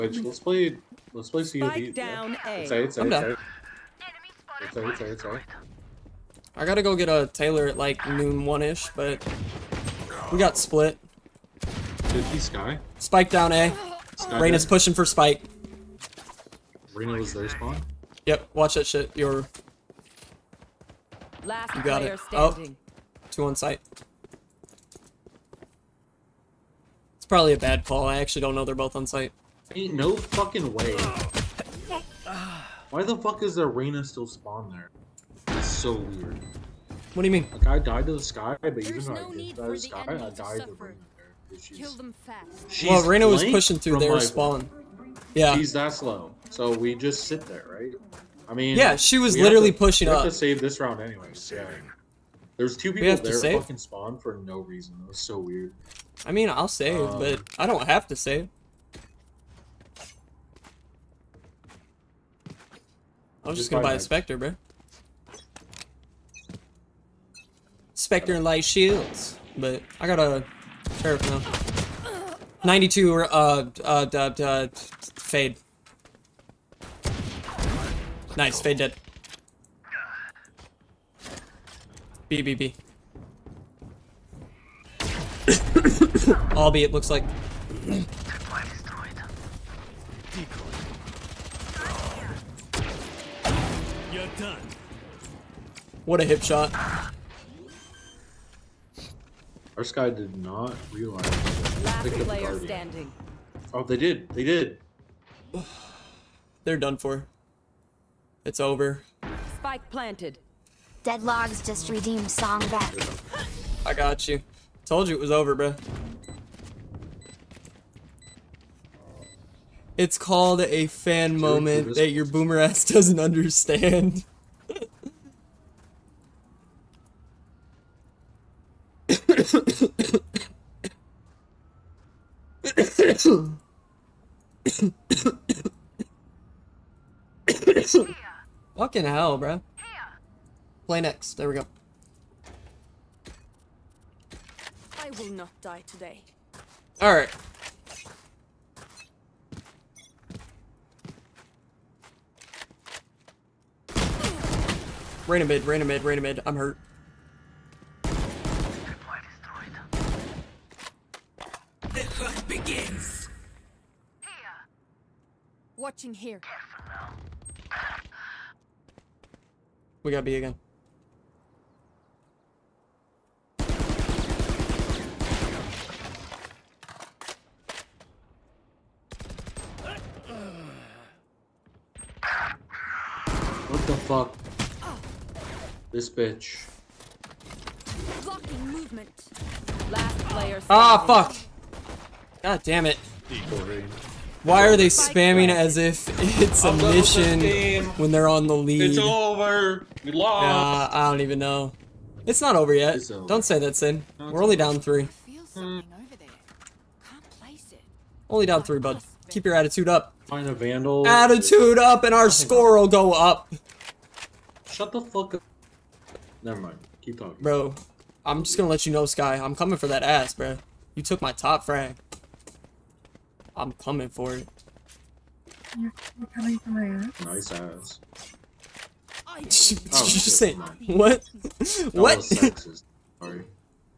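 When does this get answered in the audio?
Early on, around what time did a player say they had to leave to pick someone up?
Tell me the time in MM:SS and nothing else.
00:08.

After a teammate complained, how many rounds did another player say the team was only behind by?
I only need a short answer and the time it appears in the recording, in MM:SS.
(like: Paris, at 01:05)
3, at 03:24.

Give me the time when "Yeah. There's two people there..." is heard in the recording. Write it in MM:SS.
00:51.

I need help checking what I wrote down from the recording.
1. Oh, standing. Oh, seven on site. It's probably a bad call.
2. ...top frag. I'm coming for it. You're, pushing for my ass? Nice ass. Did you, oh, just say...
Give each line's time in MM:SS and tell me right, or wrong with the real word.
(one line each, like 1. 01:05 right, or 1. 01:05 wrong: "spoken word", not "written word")
1. 00:22 wrong: "two", not "seven"
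2. 03:41 wrong: "coming", not "pushing".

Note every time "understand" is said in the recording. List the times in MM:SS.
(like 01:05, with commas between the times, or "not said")
02:03.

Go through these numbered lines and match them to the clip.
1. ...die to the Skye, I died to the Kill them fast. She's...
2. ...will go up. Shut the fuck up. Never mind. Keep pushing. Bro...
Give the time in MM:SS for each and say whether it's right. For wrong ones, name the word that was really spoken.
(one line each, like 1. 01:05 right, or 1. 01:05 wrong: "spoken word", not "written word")
1. 00:39 right
2. 03:32 wrong: "talking", not "pushing".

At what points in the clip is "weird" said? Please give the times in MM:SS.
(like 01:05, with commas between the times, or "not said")
00:35, 00:55.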